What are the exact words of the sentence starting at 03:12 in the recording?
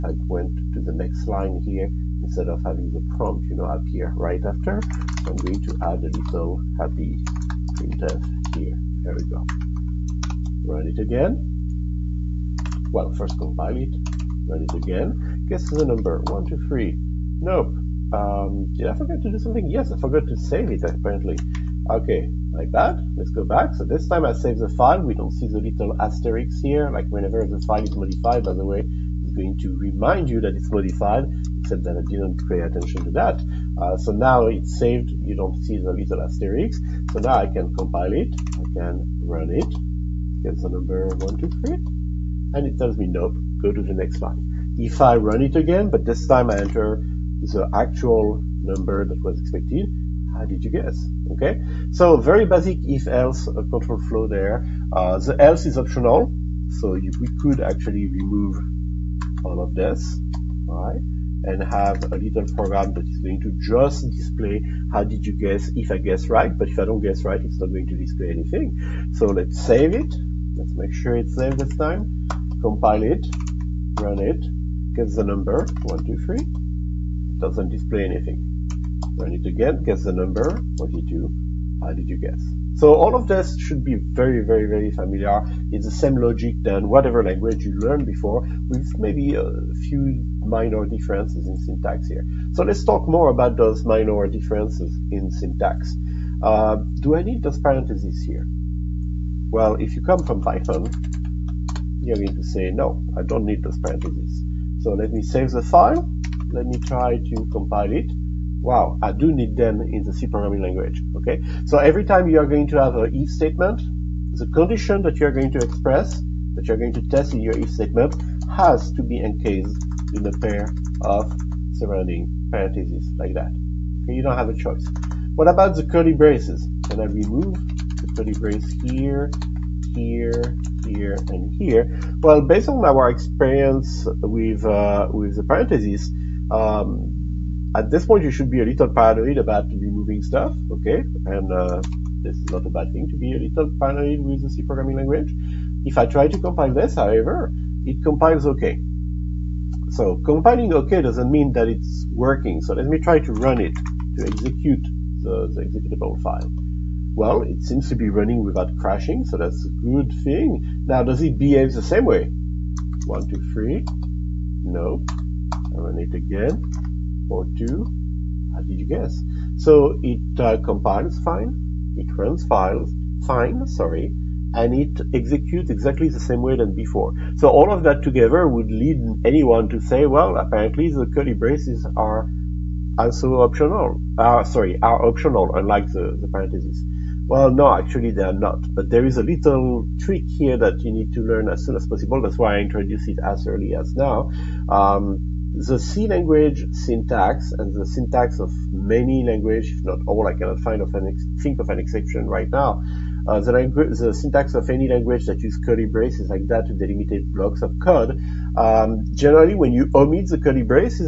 That's why I introduce it as early as now.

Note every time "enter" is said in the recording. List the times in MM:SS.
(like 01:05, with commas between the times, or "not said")
00:46.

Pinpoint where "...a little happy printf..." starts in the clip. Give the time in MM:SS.
00:06.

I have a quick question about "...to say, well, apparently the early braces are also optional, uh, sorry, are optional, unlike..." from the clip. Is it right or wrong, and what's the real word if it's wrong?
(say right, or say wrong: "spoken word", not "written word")
wrong: "curly", not "early".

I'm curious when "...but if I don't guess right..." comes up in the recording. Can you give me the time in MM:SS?
01:06.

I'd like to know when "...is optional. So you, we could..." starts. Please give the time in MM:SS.
00:55.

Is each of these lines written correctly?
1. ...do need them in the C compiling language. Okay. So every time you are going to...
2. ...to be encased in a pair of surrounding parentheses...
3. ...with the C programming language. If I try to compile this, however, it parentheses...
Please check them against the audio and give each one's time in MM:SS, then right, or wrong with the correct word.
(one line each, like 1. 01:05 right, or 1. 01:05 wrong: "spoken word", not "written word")
1. 01:49 wrong: "programming", not "compiling"
2. 01:58 right
3. 02:24 wrong: "compiles", not "parentheses".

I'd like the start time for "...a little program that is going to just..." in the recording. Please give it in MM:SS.
01:02.